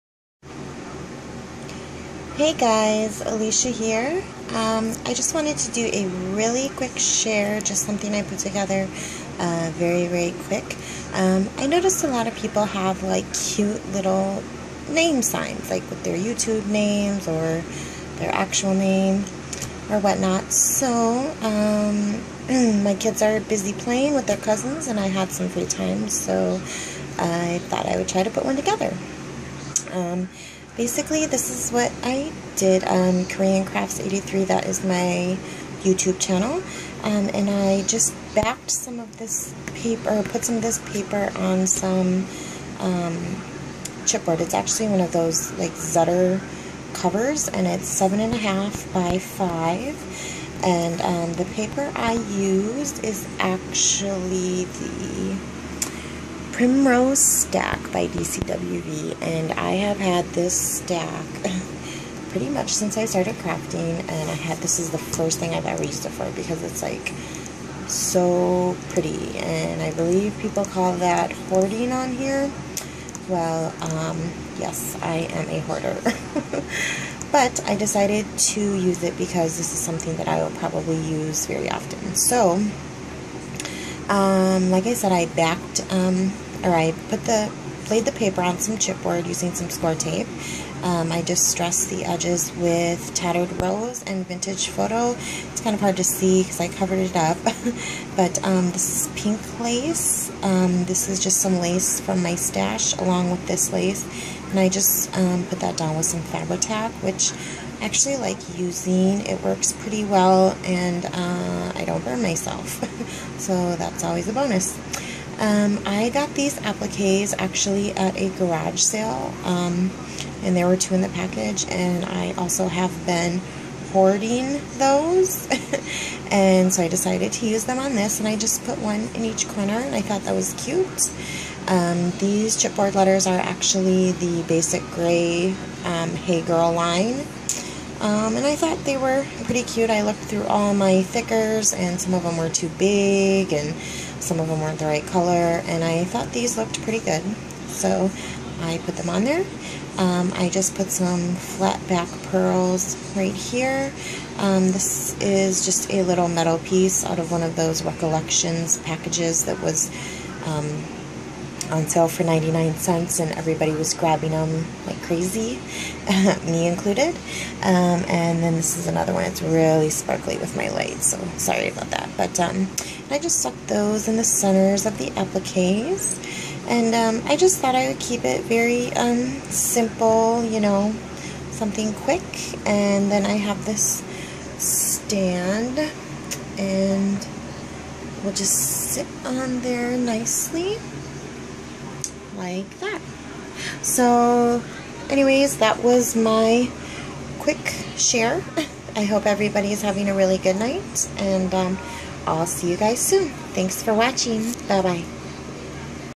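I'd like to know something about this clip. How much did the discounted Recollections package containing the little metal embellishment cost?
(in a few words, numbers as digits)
99 cents.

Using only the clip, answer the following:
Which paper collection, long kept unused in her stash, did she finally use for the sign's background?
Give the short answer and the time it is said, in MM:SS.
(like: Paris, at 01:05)
Primrose Stack, at 00:56.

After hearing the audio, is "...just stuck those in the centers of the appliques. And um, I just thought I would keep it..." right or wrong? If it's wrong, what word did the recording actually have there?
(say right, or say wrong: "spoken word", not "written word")
right.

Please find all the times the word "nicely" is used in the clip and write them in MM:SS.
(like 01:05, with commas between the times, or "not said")
03:09.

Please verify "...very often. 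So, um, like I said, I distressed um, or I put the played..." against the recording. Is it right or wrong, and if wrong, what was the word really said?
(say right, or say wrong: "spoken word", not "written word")
wrong: "backed", not "distressed".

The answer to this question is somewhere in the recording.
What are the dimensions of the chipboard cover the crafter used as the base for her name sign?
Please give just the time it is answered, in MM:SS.
00:47.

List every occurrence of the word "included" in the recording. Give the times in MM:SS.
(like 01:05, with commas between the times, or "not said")
02:46.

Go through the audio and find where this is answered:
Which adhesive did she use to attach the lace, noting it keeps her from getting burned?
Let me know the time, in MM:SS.
01:46.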